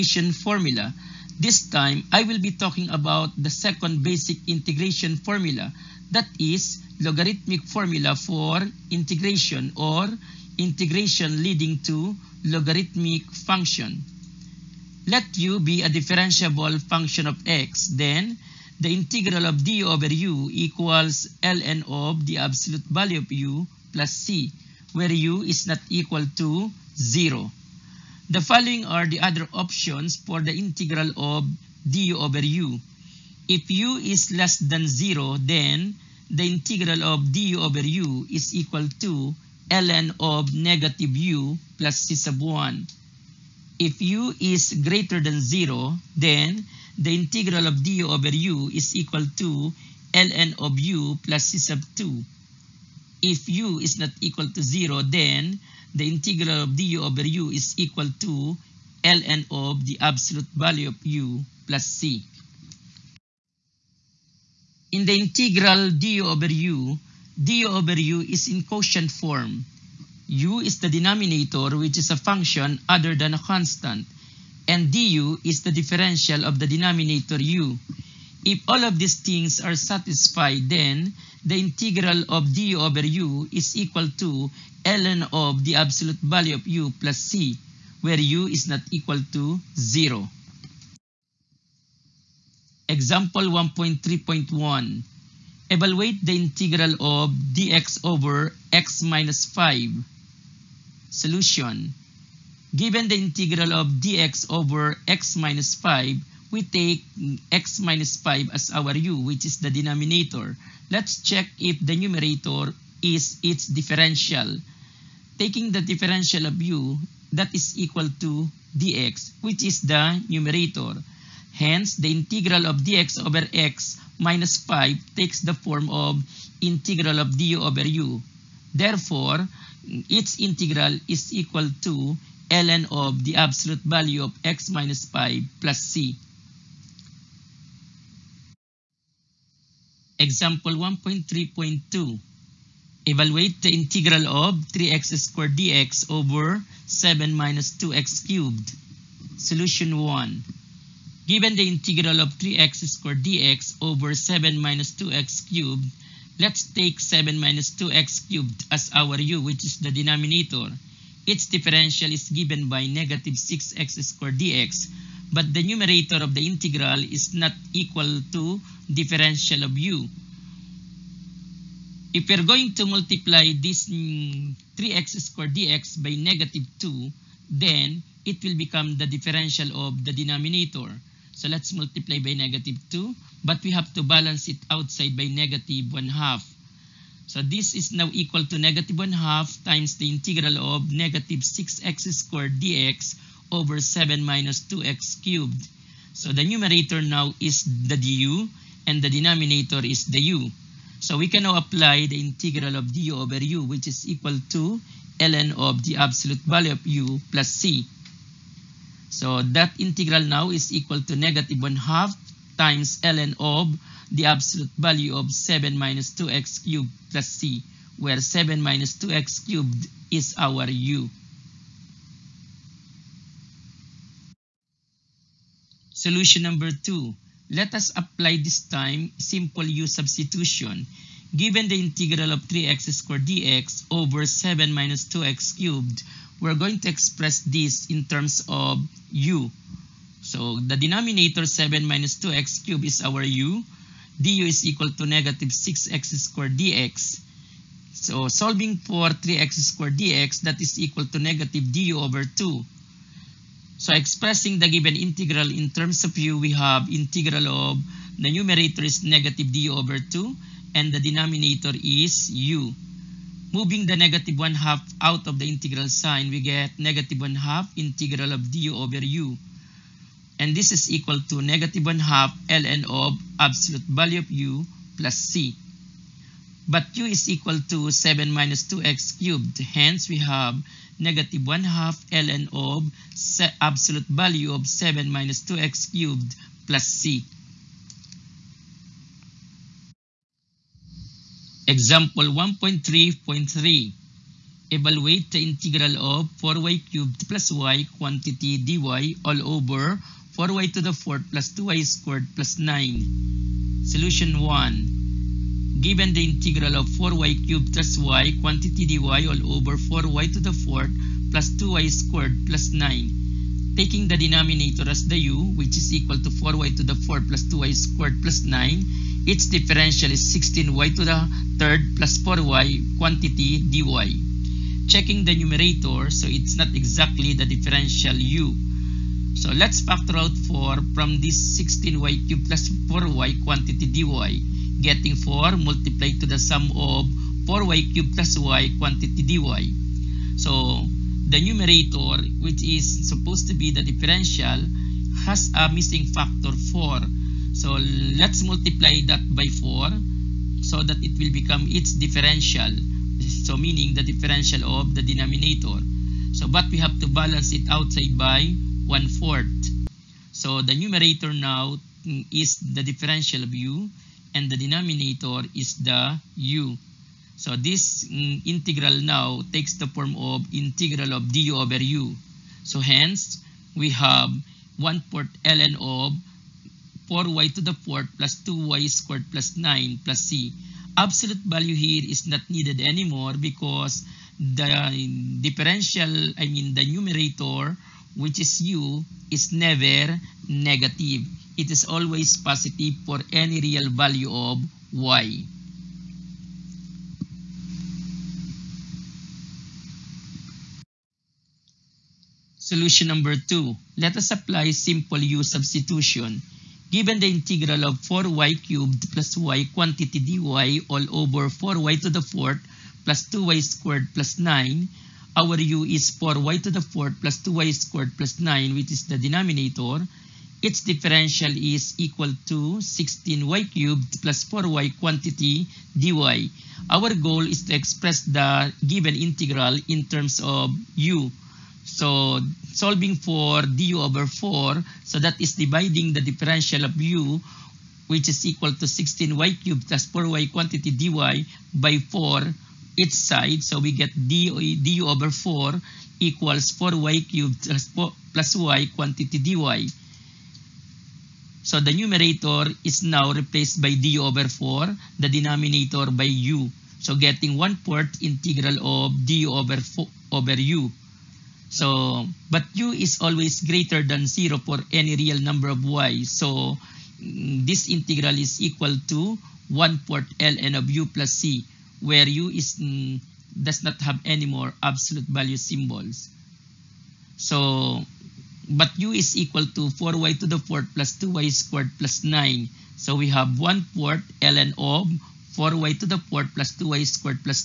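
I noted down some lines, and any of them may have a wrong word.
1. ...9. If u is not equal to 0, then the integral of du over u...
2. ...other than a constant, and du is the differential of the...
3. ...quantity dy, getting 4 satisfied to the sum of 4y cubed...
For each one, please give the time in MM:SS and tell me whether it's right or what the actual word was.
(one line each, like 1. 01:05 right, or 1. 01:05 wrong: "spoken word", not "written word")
1. 00:51 wrong: "2", not "9"
2. 01:12 right
3. 05:33 wrong: "multiplied", not "satisfied".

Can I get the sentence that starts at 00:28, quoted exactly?
The following are the other options for the integral of du over u.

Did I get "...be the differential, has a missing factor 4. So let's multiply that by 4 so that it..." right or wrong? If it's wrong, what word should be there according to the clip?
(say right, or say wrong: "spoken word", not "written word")
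right.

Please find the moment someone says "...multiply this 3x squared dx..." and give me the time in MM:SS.
02:52.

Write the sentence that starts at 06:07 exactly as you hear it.
So this mm, integral now takes the form of integral of du over u.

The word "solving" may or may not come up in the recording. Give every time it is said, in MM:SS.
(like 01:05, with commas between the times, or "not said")
04:08, 07:12.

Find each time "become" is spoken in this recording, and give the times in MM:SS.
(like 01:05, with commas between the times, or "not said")
02:58, 05:51.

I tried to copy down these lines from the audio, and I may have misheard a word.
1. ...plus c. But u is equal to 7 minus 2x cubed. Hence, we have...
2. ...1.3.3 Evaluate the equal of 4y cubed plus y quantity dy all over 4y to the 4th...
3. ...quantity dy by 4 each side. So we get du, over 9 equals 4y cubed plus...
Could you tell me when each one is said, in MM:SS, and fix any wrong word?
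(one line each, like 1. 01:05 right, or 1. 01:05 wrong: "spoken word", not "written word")
1. 04:34 right
2. 04:52 wrong: "integral", not "equal"
3. 07:20 wrong: "4", not "9".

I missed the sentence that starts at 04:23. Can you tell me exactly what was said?
Moving the negative 1 half out of the integral sign, we get negative 1 half integral of du over u.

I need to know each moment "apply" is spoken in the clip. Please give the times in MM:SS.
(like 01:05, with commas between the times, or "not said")
03:21, 03:47, 06:44.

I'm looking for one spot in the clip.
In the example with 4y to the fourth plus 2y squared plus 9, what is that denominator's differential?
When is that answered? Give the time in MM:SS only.
05:20.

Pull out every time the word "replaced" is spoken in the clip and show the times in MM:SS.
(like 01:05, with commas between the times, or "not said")
07:33.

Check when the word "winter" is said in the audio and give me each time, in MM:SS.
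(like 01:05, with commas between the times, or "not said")
not said.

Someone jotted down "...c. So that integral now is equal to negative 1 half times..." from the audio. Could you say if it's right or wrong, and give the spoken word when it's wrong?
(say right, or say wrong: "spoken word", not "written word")
right.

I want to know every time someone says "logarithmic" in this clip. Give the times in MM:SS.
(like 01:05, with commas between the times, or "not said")
00:07, 00:12.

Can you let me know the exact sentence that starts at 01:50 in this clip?
Let's check if the numerator is its differential.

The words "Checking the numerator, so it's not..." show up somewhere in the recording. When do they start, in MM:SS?
05:24.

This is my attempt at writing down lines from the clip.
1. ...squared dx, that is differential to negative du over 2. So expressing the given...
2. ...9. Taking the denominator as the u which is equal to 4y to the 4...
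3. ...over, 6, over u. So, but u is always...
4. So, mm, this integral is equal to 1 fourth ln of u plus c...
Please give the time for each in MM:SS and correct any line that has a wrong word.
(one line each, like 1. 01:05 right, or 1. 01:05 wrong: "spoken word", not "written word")
1. 04:09 wrong: "equal", not "differential"
2. 05:12 right
3. 07:39 wrong: "4", not "6"
4. 07:46 right.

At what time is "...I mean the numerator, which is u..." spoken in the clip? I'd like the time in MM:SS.
06:26.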